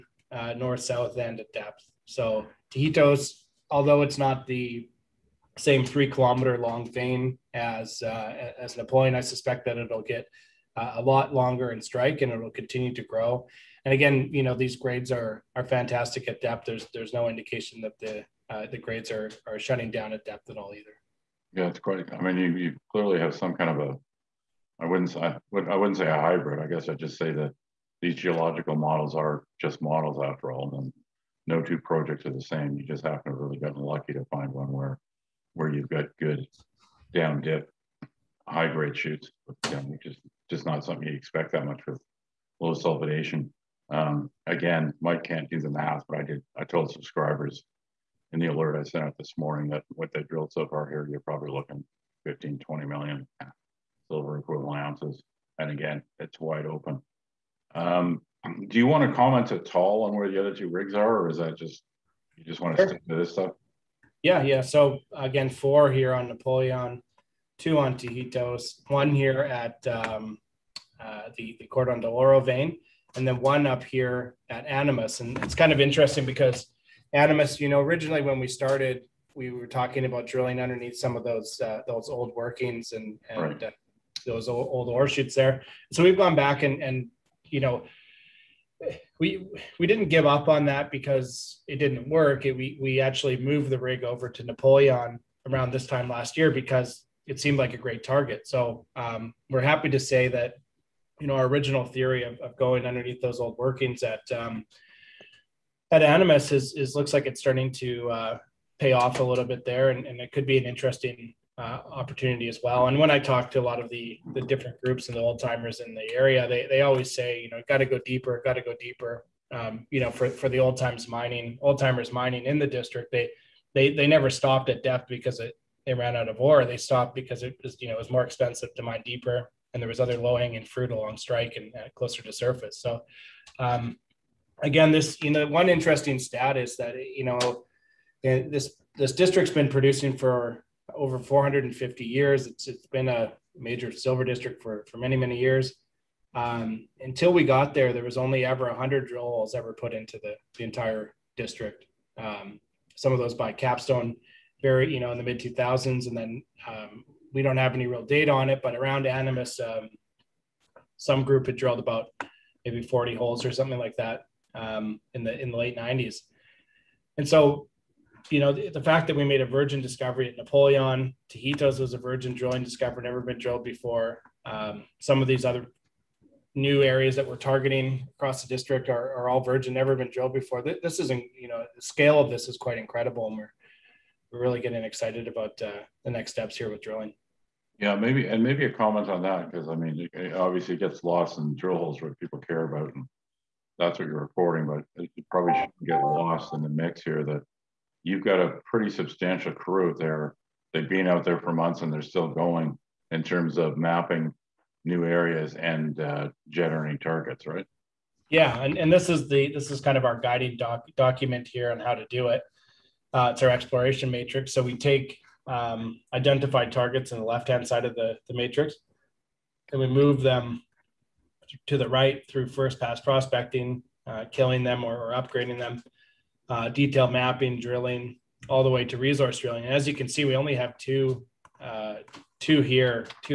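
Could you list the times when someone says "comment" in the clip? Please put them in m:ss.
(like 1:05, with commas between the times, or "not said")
0:59, 3:08.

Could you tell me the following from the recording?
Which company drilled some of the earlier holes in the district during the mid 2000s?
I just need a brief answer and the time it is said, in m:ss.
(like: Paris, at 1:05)
Capstone, at 2:33.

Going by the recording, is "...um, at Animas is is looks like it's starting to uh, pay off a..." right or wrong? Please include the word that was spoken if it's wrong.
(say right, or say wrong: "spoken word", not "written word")
right.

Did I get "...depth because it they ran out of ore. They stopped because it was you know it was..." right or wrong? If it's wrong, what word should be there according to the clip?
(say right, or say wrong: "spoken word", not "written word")
right.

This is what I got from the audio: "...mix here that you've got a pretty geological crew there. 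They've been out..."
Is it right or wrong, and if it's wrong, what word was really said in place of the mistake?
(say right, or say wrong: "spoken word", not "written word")
wrong: "substantial", not "geological".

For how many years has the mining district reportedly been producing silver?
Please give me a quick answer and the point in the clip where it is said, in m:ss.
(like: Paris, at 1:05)
over 450 years, at 2:20.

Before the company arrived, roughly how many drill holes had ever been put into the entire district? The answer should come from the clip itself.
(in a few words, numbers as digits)
100.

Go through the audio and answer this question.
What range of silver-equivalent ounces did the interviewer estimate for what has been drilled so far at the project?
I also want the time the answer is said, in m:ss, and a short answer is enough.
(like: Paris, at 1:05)
15 to 20 million, at 0:52.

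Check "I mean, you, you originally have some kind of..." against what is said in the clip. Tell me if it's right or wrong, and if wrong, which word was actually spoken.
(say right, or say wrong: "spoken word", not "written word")
wrong: "clearly", not "originally".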